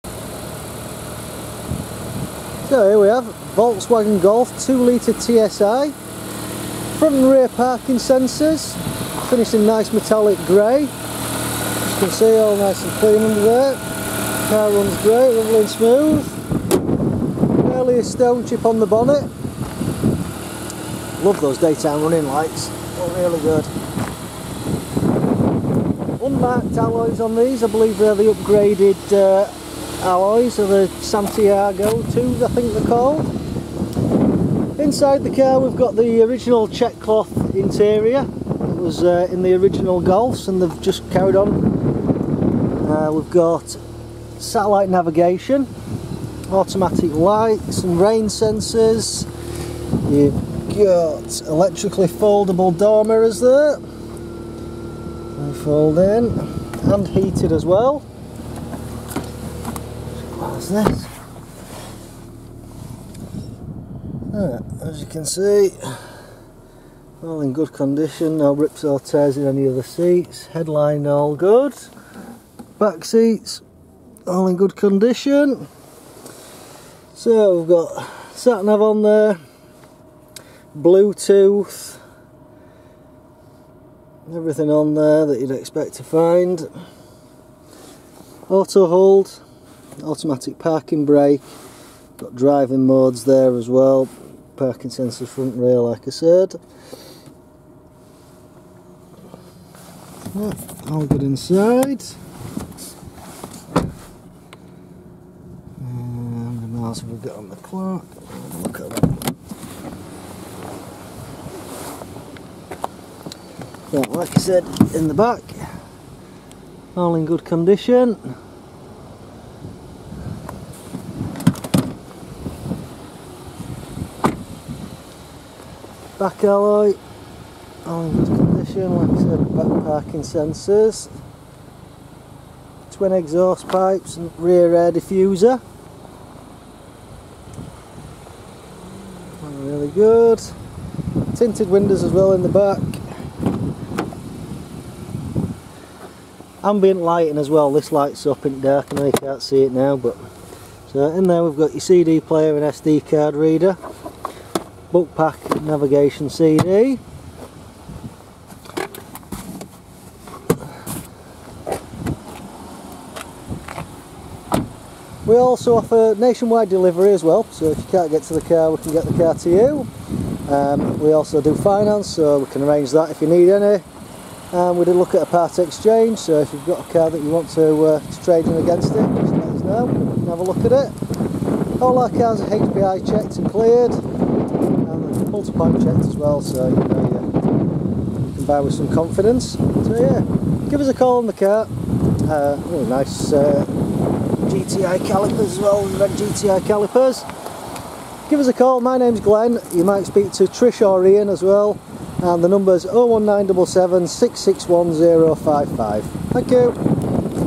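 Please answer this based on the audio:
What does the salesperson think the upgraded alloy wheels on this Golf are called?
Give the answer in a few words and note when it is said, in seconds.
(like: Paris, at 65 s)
Santiago 2s, at 31 s.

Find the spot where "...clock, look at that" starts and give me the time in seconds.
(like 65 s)
107 s.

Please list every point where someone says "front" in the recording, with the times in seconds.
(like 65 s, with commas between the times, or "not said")
6 s, 95 s.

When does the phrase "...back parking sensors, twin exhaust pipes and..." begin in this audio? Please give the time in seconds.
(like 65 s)
129 s.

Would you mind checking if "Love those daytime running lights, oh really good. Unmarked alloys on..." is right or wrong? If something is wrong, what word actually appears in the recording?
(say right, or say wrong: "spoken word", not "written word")
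right.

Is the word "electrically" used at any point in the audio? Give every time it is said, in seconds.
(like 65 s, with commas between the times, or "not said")
51 s.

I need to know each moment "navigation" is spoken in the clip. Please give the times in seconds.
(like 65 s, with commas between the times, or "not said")
44 s, 155 s.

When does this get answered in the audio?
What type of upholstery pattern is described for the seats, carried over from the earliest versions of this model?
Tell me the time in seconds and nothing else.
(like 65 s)
36 s.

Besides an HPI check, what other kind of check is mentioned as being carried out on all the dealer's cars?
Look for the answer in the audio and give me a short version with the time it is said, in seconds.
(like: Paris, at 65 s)
pulse pipe, at 185 s.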